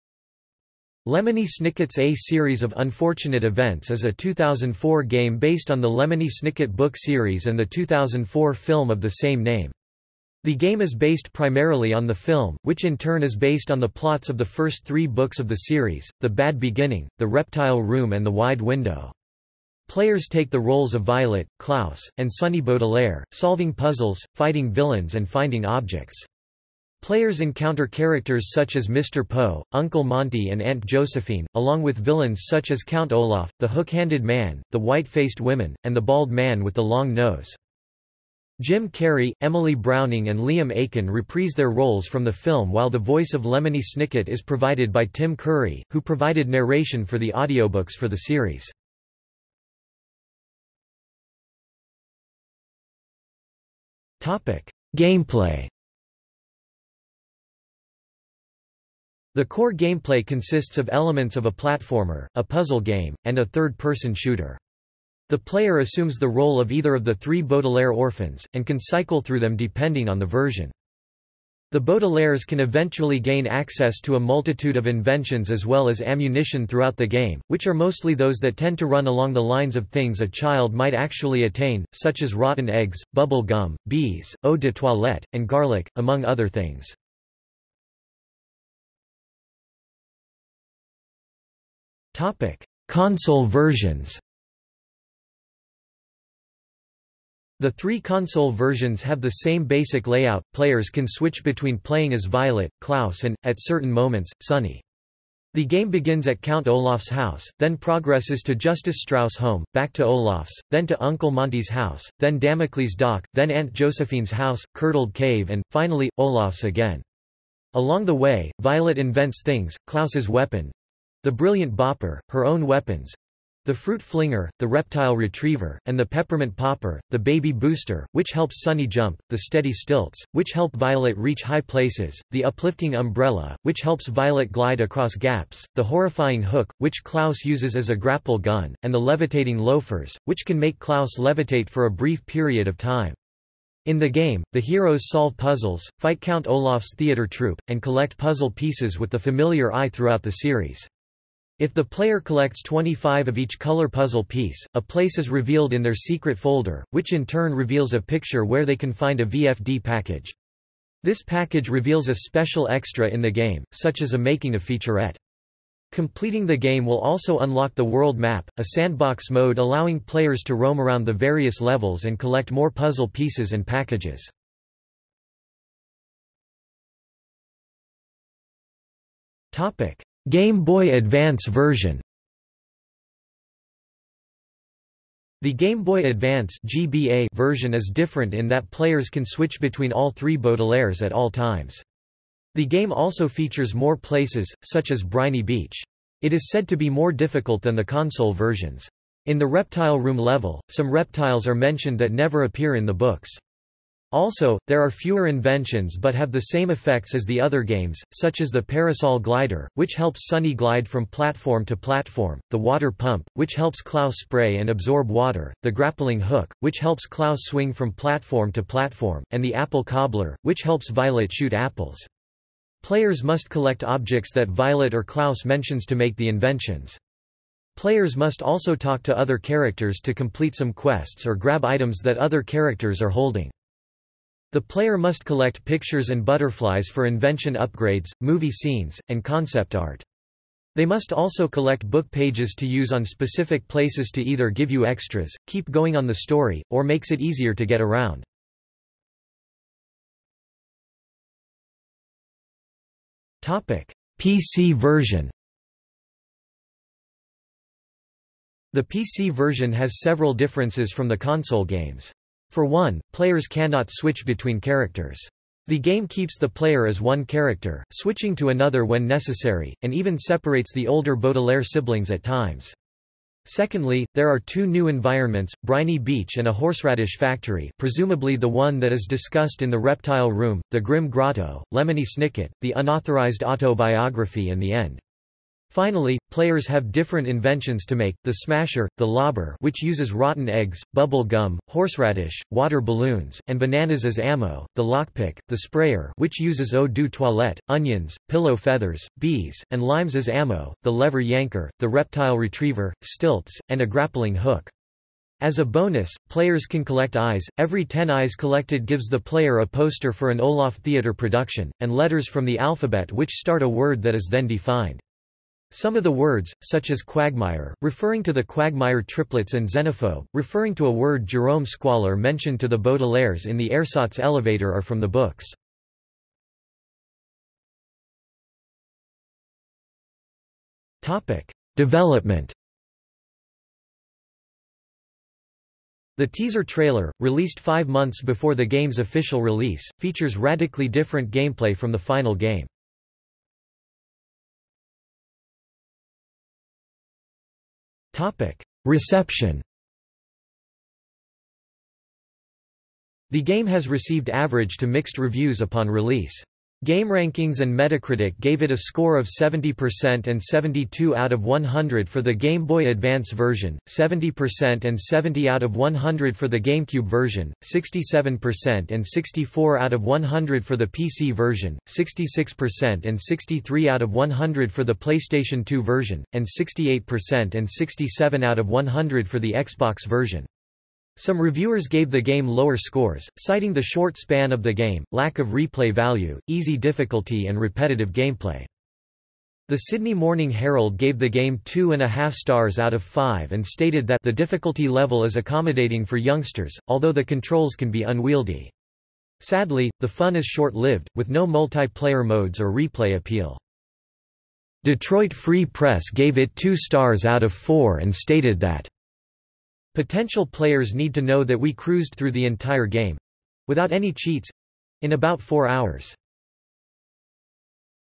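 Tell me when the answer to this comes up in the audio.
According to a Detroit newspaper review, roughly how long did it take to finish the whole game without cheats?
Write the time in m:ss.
6:55.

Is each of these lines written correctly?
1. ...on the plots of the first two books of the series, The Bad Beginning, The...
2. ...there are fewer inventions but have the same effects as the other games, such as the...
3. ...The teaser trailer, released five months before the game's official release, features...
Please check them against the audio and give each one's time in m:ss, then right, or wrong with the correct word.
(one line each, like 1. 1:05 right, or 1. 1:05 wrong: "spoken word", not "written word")
1. 0:13 wrong: "three", not "two"
2. 3:24 right
3. 5:36 right.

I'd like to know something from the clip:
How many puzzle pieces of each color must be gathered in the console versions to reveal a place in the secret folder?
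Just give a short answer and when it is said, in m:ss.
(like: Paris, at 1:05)
25, at 2:32.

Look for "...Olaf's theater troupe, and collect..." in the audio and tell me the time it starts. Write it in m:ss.
2:26.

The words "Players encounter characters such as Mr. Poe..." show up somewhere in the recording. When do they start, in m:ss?
0:27.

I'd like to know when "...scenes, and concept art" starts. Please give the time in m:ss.
3:58.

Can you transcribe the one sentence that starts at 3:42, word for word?
Players must collect objects that Violet or Klaus mentions to make the inventions.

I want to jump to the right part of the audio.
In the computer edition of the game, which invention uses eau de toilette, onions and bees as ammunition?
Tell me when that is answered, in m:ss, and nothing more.
4:55.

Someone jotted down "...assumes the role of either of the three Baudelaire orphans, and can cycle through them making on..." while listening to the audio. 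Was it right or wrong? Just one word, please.
wrong.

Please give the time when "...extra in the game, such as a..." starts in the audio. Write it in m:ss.
2:42.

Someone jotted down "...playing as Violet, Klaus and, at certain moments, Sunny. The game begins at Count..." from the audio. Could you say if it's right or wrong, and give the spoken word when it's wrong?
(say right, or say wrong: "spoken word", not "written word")
right.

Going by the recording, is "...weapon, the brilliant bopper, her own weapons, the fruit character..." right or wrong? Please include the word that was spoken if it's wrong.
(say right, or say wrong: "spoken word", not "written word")
wrong: "flinger", not "character".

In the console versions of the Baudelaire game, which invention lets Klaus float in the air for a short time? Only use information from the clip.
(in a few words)
levitating loafers.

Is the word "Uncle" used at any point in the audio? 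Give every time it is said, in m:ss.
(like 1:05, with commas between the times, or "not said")
0:29, 1:51.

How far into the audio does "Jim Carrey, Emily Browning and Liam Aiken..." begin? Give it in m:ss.
0:38.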